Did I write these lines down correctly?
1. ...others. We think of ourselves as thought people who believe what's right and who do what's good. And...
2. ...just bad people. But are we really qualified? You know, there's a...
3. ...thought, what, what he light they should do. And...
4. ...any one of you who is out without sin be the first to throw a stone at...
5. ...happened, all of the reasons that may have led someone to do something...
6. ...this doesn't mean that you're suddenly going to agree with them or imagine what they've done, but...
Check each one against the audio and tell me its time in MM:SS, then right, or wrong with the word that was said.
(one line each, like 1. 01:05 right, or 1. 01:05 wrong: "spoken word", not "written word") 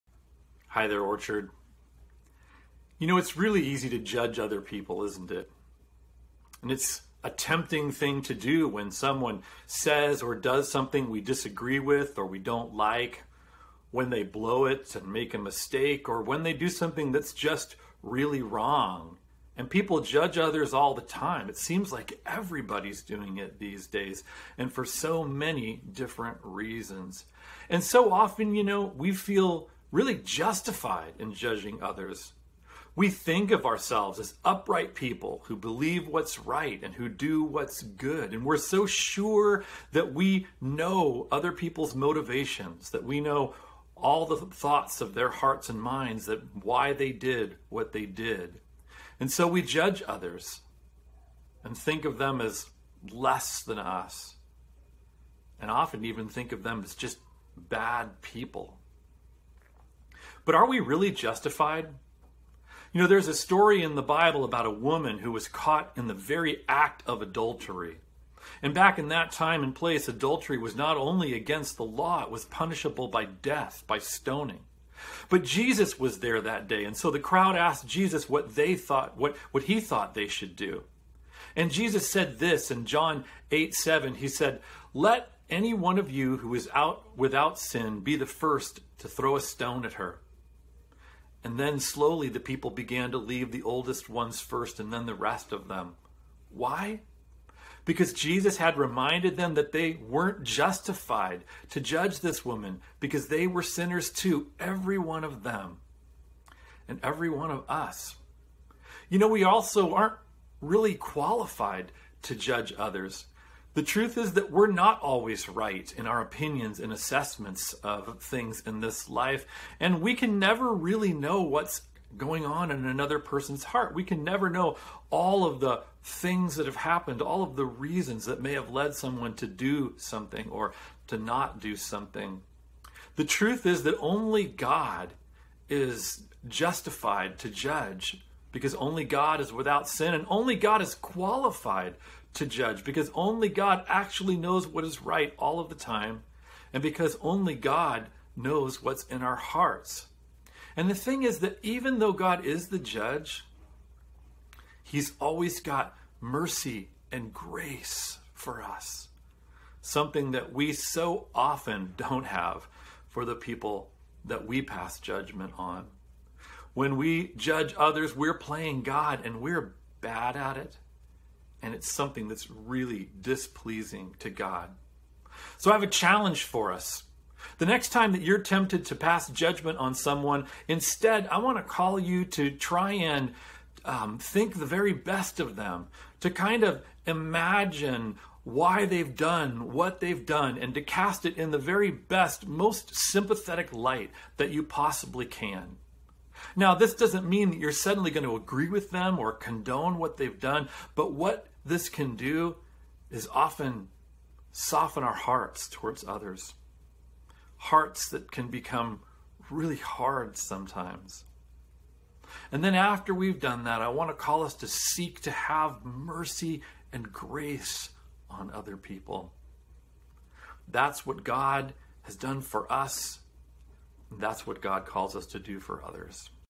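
1. 00:31 wrong: "upright", not "thought"
2. 00:56 wrong: "justified", not "qualified"
3. 01:18 wrong: "thought", not "light"
4. 01:25 right
5. 02:06 right
6. 03:16 wrong: "condone", not "imagine".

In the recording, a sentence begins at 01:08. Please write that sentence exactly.
And back in that time and place, adultery was not only against the law, it was punishable by death, by stoning.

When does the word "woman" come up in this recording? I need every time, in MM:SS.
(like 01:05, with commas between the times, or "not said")
01:04, 01:42.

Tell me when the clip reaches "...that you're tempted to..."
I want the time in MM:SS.
02:58.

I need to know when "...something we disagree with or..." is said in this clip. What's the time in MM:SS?
00:10.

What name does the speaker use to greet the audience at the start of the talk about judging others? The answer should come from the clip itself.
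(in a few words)
Orchard.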